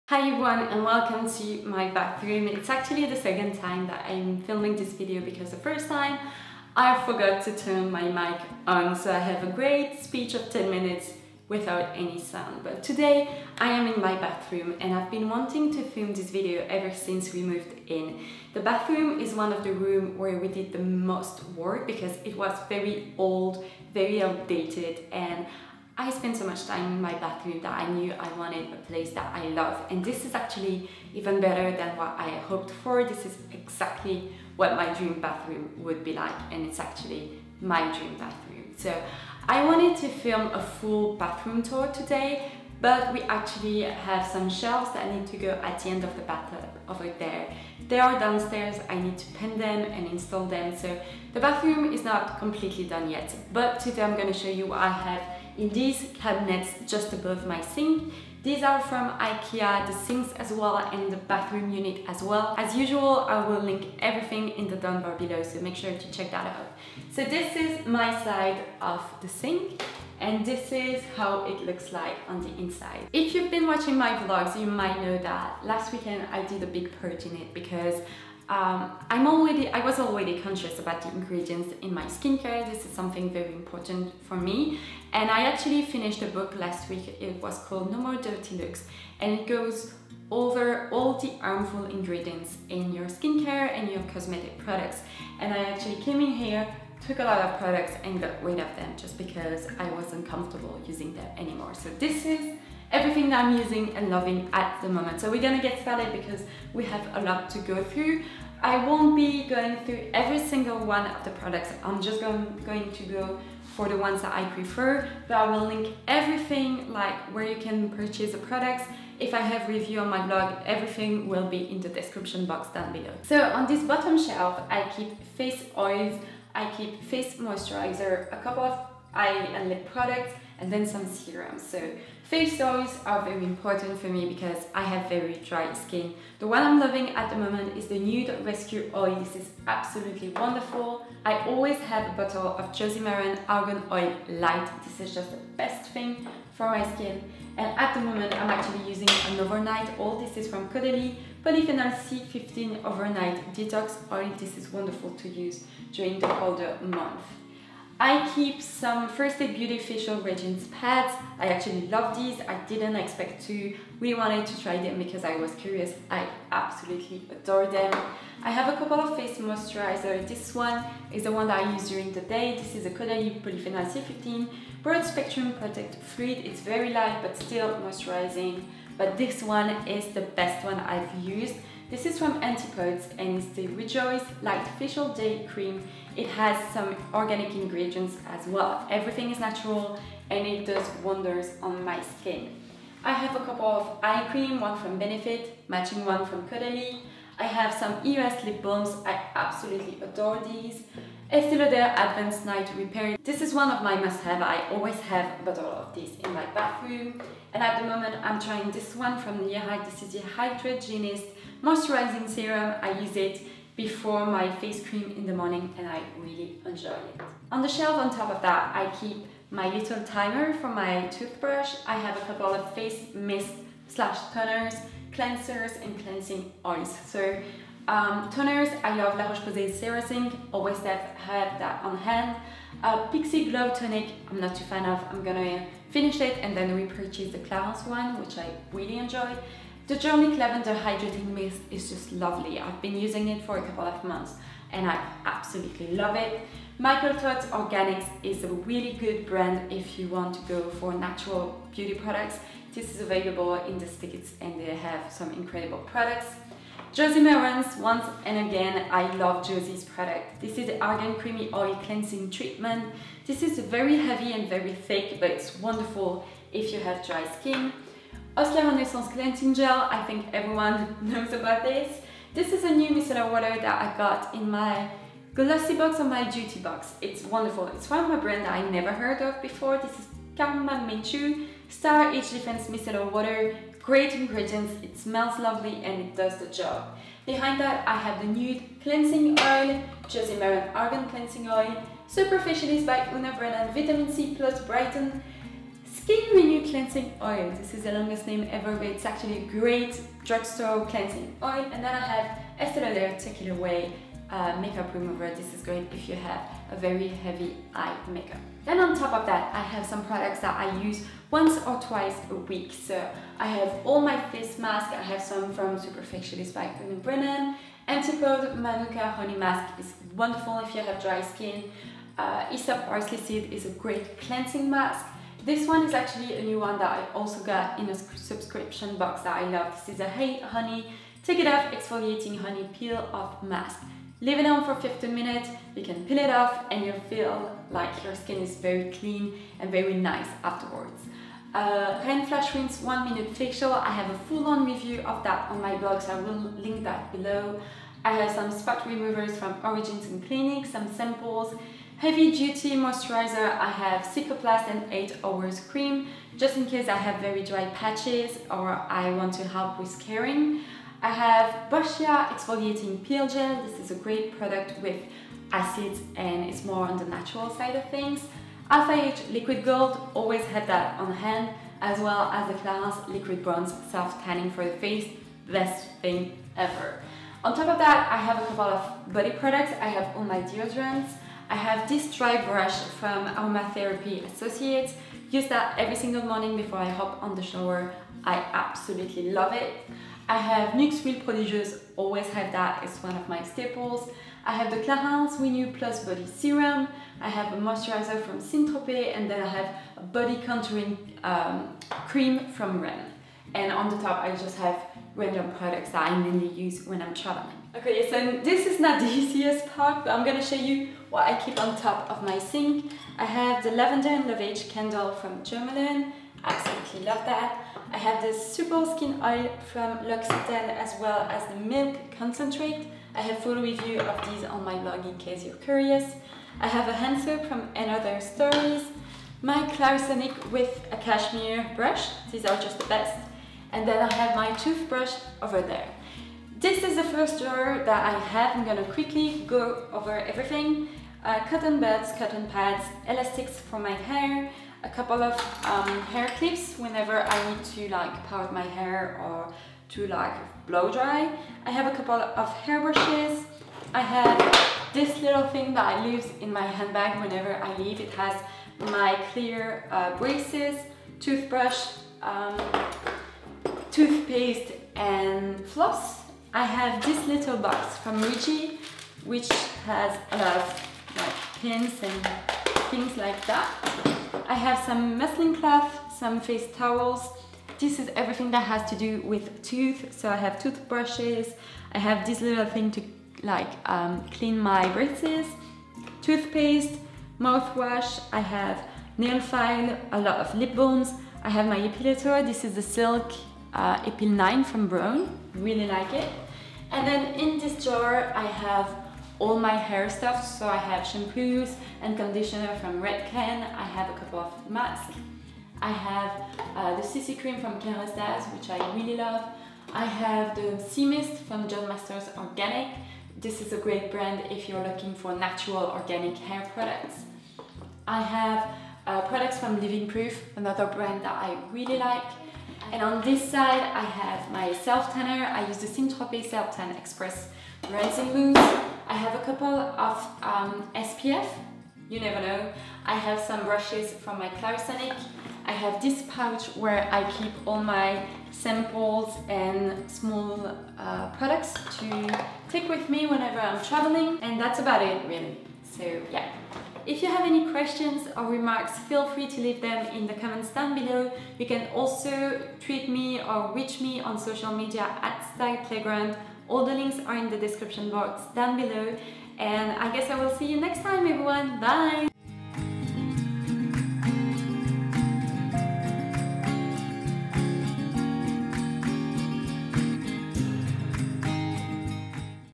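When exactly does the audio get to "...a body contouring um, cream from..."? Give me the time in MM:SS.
06:39.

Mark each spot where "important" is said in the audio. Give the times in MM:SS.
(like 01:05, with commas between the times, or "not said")
01:23, 02:13.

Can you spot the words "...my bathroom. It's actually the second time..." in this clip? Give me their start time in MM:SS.
00:01.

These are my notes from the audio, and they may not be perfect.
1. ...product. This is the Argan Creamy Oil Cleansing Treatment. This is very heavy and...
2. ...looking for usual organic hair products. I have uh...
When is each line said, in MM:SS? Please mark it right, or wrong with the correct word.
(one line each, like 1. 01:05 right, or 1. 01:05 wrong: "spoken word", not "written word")
1. 04:19 right
2. 08:34 wrong: "natural", not "usual".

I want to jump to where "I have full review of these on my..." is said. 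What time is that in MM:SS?
07:03.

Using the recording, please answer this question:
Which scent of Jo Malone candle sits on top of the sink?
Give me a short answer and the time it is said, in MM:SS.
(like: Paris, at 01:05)
Lavender and Lovage, at 06:53.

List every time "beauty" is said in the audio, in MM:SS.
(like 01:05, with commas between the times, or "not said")
02:39, 04:11.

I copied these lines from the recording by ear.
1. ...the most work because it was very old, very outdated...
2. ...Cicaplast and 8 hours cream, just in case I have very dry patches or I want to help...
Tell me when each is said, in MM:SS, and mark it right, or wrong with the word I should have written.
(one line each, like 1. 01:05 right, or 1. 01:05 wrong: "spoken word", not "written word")
1. 00:20 right
2. 05:54 right.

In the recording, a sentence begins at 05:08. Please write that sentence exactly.
Then on top of that, I have some products that I use once or twice a week.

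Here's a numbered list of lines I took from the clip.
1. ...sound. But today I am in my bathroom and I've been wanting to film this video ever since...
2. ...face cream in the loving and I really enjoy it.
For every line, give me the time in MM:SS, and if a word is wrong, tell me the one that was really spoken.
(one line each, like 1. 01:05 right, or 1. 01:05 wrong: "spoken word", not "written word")
1. 00:12 right
2. 03:34 wrong: "morning", not "loving".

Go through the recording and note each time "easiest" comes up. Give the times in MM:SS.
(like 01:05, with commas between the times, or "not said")
06:49.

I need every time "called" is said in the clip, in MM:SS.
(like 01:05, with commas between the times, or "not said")
01:27.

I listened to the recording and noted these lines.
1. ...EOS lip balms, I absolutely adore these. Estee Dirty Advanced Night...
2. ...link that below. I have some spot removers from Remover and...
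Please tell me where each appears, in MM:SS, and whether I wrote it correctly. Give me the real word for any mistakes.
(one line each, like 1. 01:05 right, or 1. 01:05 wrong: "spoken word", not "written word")
1. 03:18 wrong: "Lauder", not "Dirty"
2. 05:46 wrong: "Origins", not "Remover".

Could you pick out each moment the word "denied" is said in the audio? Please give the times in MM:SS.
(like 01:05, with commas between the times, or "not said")
not said.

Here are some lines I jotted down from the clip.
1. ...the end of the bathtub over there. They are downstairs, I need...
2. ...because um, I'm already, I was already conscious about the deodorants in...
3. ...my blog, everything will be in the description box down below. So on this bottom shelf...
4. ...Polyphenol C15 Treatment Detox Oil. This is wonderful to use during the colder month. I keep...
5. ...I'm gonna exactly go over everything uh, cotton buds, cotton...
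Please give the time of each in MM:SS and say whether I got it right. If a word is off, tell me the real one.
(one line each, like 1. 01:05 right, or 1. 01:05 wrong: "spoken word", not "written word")
1. 00:45 right
2. 01:17 wrong: "ingredients", not "deodorants"
3. 02:00 right
4. 02:31 wrong: "Overnight", not "Treatment"
5. 07:18 wrong: "quickly", not "exactly".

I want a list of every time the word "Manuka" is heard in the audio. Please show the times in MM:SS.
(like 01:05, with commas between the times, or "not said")
05:18.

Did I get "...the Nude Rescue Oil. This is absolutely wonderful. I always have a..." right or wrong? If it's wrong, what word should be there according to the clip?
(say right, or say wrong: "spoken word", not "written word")
right.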